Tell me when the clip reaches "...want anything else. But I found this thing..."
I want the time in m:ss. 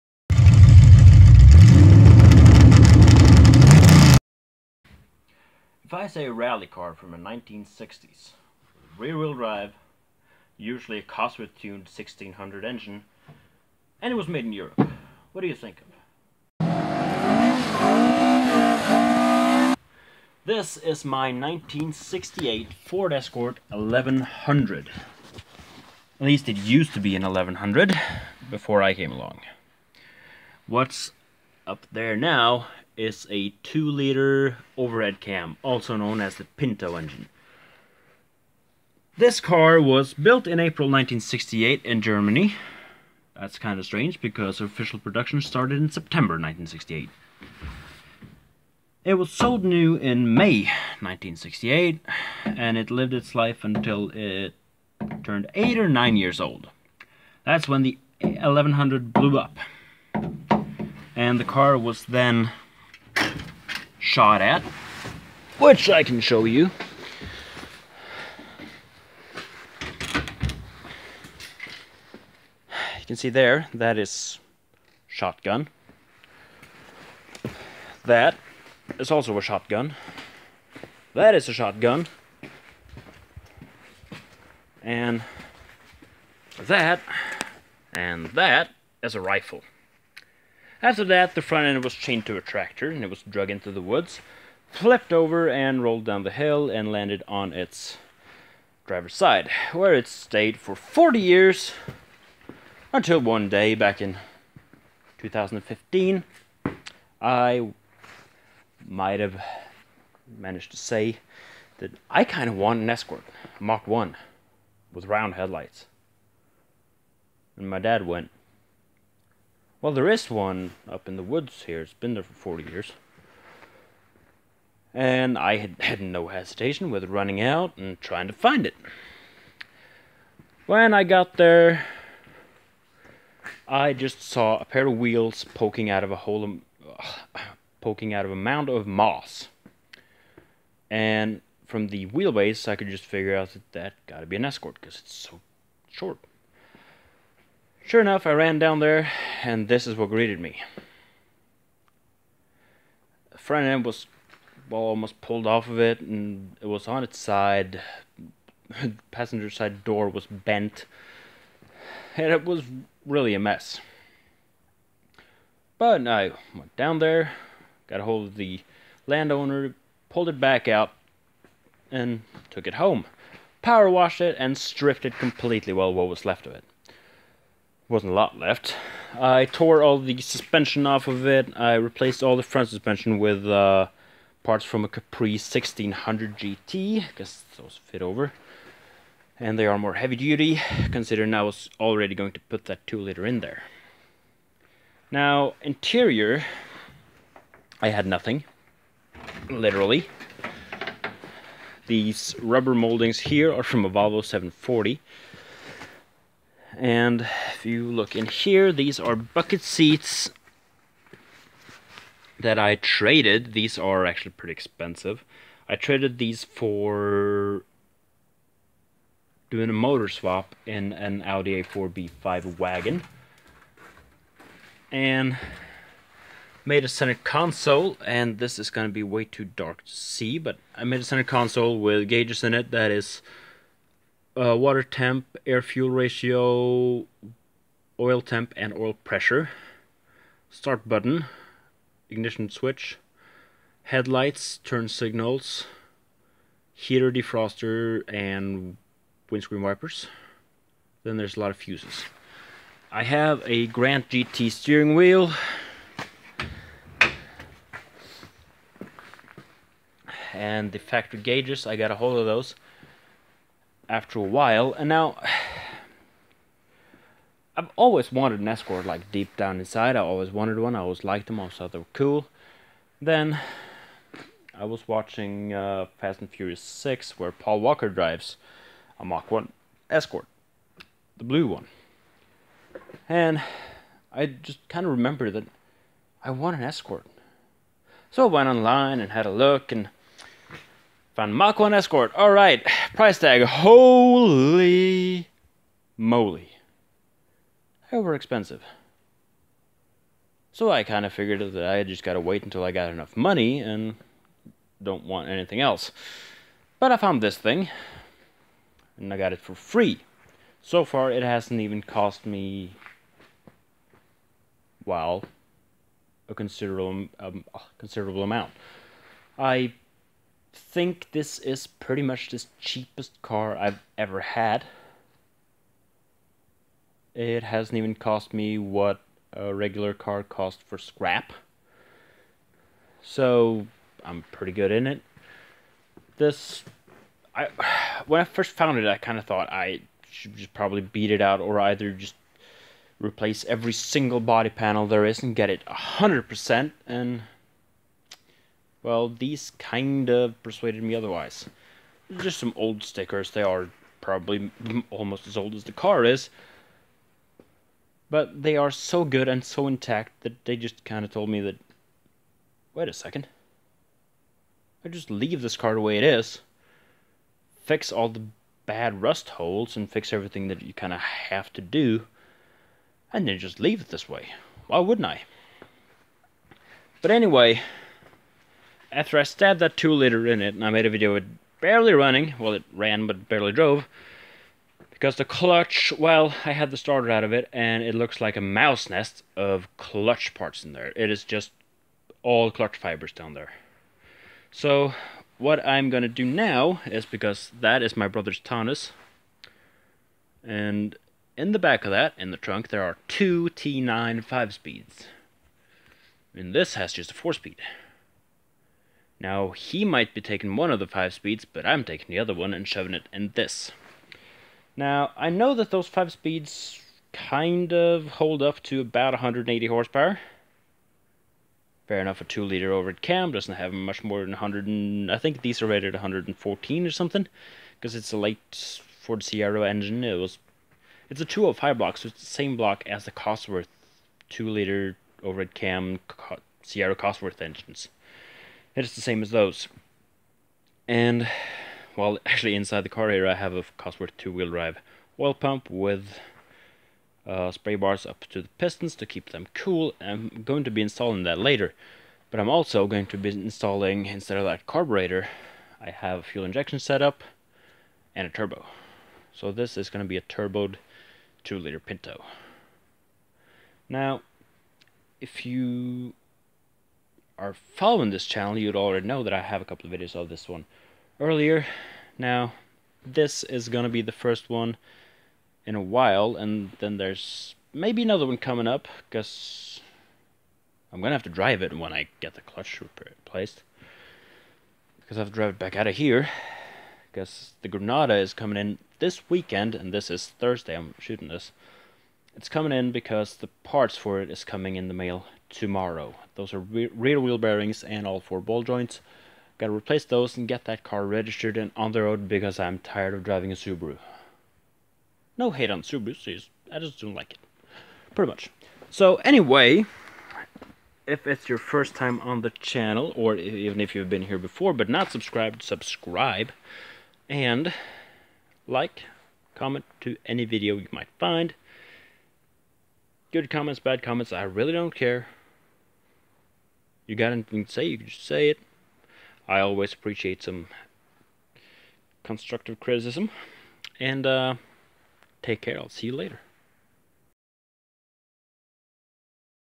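5:05.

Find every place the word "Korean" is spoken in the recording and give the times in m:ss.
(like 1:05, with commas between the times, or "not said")
not said.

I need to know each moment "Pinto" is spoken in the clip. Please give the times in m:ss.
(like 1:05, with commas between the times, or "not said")
0:36, 7:41.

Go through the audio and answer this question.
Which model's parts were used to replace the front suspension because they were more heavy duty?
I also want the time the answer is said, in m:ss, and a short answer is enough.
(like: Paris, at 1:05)
Capri 1600 GT, at 3:04.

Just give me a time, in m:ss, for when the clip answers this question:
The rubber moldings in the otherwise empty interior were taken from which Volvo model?
3:23.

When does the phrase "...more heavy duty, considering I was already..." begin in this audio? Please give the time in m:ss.
3:09.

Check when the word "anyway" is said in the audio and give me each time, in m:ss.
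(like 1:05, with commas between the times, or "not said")
6:17, 8:29.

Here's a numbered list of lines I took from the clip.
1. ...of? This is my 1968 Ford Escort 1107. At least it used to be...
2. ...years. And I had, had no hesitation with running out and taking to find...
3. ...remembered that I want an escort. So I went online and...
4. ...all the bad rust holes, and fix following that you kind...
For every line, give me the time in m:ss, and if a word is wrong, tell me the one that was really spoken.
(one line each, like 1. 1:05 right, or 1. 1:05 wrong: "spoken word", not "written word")
1. 0:15 wrong: "1100", not "1107"
2. 2:02 wrong: "trying", not "taking"
3. 4:44 right
4. 6:07 wrong: "everything", not "following".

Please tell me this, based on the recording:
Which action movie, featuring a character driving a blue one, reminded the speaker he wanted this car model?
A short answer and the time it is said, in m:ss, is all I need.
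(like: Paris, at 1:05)
Fast and Furious 6, at 4:35.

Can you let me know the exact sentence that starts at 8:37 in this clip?
And like, comment to any video you might find.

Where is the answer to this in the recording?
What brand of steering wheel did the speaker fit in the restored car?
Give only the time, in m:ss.
4:13.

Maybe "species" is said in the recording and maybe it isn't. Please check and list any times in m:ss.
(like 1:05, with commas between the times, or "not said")
not said.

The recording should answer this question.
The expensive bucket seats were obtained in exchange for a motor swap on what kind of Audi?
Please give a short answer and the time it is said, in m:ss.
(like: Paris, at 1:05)
Audi A4B5 wagon, at 3:41.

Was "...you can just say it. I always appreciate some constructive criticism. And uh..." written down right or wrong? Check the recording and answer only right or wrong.
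right.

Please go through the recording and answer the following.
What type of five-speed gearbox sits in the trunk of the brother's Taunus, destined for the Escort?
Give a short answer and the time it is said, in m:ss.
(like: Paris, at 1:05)
T9, at 6:43.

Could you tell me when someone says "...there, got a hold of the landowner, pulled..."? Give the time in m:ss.
2:46.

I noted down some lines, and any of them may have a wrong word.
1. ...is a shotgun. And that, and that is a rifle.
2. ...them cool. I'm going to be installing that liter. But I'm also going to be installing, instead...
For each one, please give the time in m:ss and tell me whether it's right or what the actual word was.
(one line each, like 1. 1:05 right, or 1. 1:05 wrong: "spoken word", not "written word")
1. 1:21 right
2. 7:29 wrong: "later", not "liter".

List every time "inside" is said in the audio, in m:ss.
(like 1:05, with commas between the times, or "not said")
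4:29, 7:22.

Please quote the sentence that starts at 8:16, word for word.
Those are re rear wheel bearings and all four ball joints.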